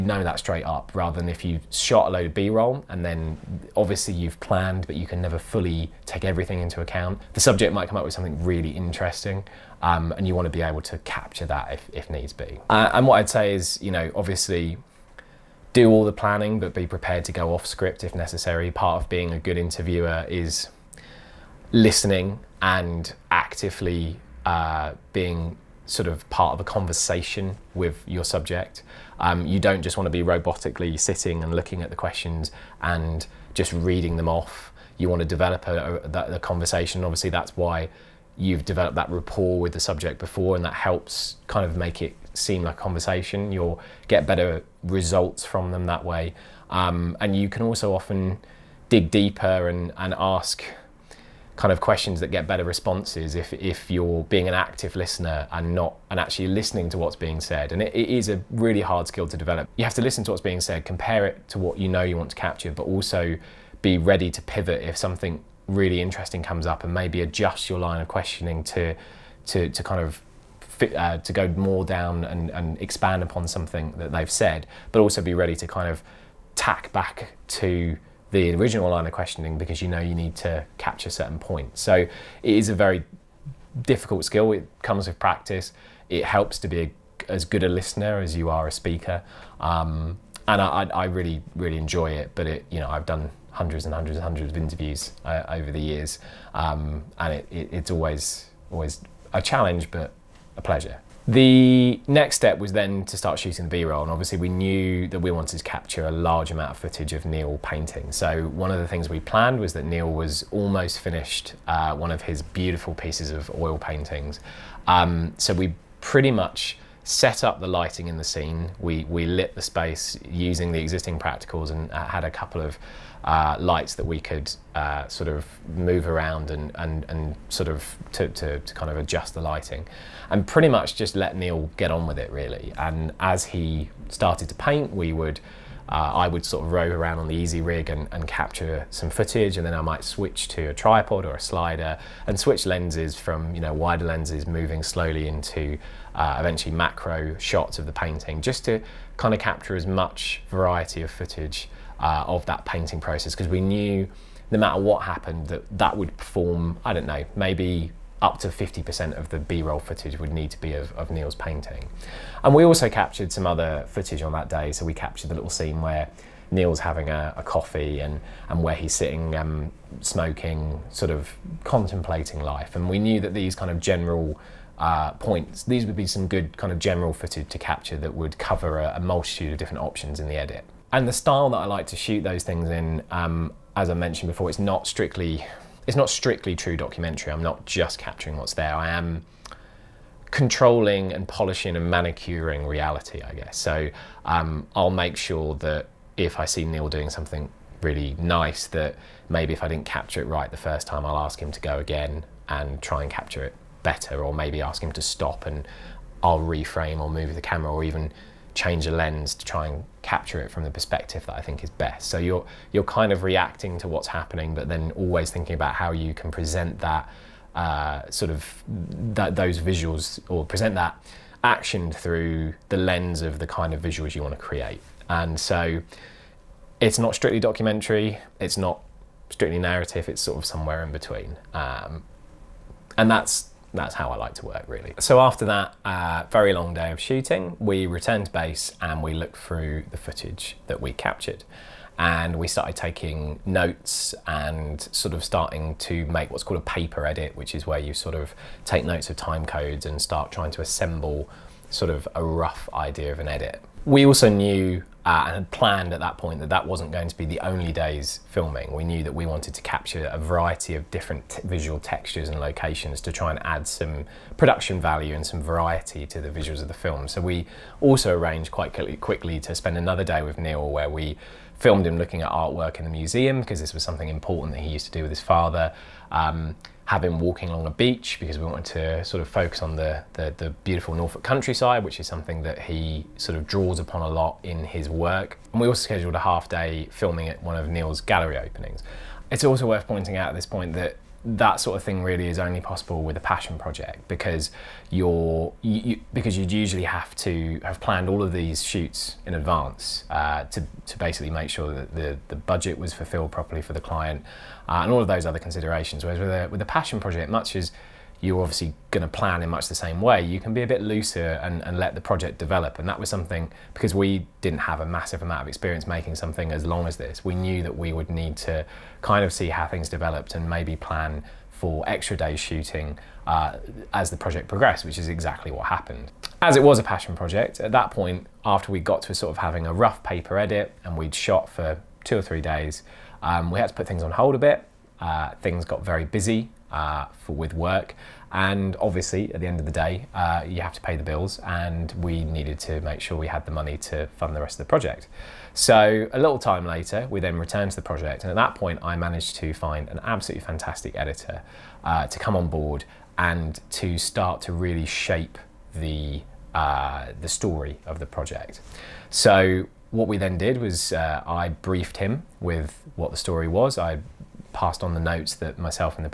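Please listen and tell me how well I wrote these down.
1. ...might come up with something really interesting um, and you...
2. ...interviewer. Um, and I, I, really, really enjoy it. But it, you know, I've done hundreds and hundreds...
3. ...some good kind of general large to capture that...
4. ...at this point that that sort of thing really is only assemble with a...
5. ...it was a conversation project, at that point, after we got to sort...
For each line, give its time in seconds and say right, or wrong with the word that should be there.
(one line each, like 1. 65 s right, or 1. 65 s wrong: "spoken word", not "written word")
1. 7 s right
2. 88 s wrong: "speaker", not "interviewer"
3. 176 s wrong: "footage", not "large"
4. 290 s wrong: "possible", not "assemble"
5. 326 s wrong: "passion", not "conversation".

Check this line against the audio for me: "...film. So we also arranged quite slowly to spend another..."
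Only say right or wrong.
wrong.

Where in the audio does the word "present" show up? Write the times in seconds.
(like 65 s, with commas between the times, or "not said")
216 s, 220 s.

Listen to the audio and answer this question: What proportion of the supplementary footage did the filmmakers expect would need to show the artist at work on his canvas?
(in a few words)
50%.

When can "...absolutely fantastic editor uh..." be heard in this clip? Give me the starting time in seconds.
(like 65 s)
350 s.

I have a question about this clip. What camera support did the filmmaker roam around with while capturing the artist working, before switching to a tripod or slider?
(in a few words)
Easyrig.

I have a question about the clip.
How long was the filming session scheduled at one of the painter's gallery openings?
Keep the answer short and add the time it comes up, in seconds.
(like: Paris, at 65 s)
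half day, at 286 s.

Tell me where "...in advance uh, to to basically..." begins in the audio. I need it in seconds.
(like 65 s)
299 s.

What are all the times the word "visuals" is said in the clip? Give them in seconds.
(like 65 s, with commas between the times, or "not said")
219 s, 223 s, 261 s, 266 s.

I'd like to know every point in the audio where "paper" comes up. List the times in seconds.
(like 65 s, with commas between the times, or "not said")
246 s, 330 s.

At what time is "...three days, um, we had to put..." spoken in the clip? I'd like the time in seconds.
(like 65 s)
332 s.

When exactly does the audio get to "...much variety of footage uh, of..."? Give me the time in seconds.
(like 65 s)
149 s.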